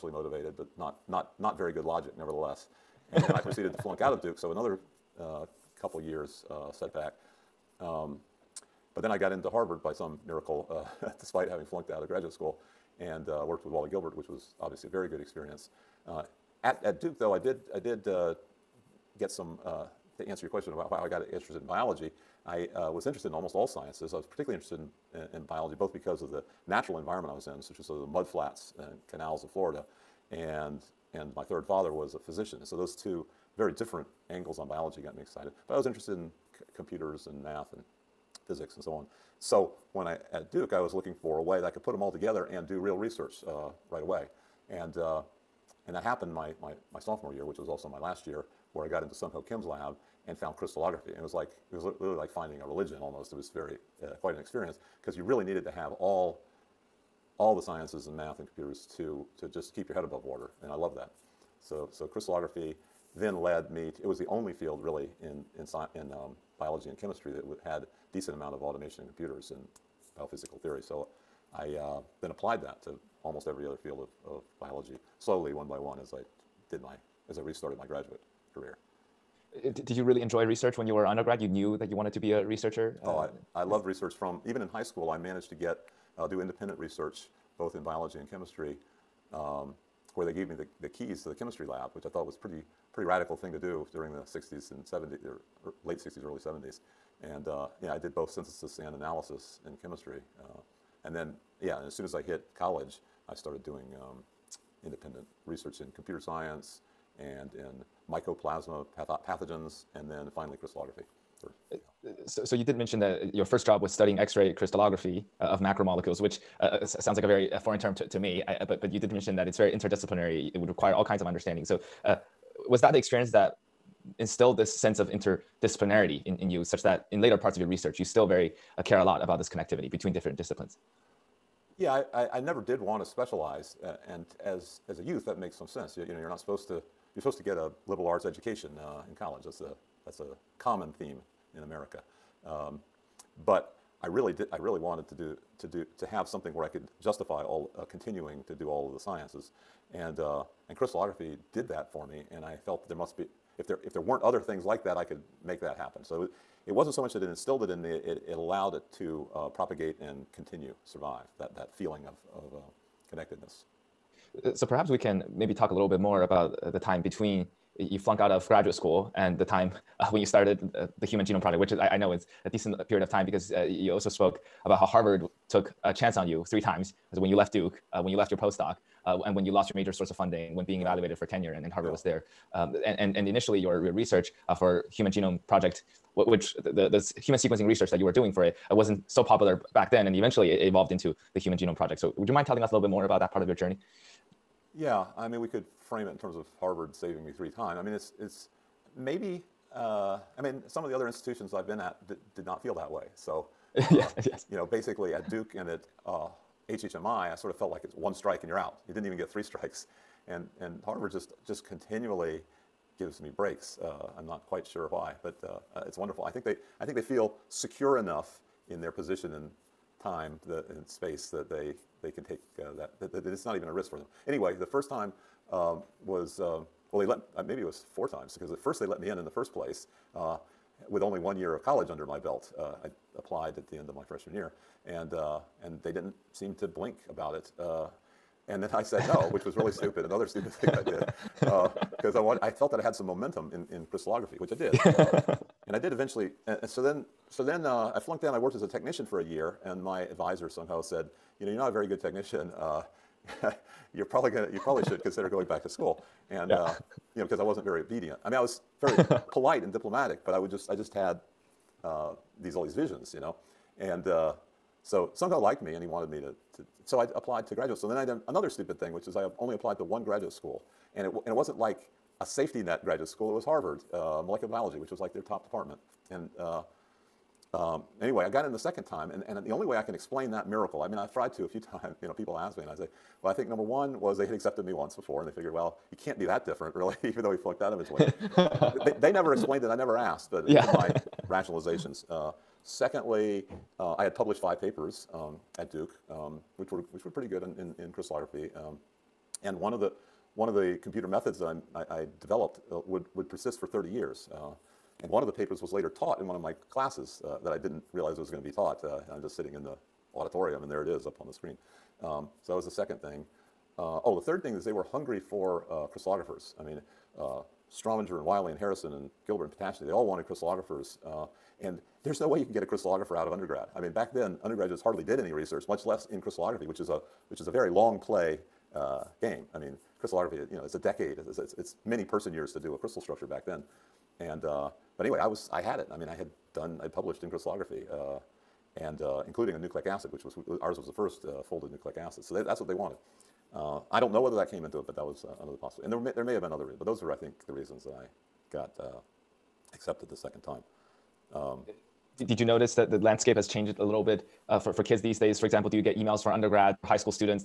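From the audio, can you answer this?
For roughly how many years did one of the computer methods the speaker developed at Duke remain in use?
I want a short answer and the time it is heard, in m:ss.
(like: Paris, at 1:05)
30, at 5:03.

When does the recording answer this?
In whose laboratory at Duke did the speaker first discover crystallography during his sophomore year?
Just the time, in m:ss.
0:49.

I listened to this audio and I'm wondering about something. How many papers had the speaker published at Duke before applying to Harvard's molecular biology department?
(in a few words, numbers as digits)
5.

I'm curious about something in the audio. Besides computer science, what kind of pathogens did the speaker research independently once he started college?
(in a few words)
mycoplasma.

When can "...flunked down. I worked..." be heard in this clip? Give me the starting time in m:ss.
4:07.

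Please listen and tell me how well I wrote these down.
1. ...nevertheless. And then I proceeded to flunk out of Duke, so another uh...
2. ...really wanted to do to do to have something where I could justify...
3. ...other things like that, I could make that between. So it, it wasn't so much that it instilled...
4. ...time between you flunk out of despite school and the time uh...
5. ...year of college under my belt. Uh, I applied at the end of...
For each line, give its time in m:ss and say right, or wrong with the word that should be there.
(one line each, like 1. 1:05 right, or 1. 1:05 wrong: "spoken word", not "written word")
1. 0:02 right
2. 2:24 right
3. 2:34 wrong: "happen", not "between"
4. 2:46 wrong: "graduate", not "despite"
5. 3:51 right.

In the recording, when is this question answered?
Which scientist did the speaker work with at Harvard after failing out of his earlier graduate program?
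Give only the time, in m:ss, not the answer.
0:13.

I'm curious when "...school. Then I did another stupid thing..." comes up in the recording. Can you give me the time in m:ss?
4:27.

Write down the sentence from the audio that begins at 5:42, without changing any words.
So they, that's what they wanted.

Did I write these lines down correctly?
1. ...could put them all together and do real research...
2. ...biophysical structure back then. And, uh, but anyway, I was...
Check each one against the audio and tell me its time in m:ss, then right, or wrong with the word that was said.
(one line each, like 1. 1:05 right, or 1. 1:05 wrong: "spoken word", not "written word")
1. 0:41 right
2. 5:32 wrong: "crystal", not "biophysical".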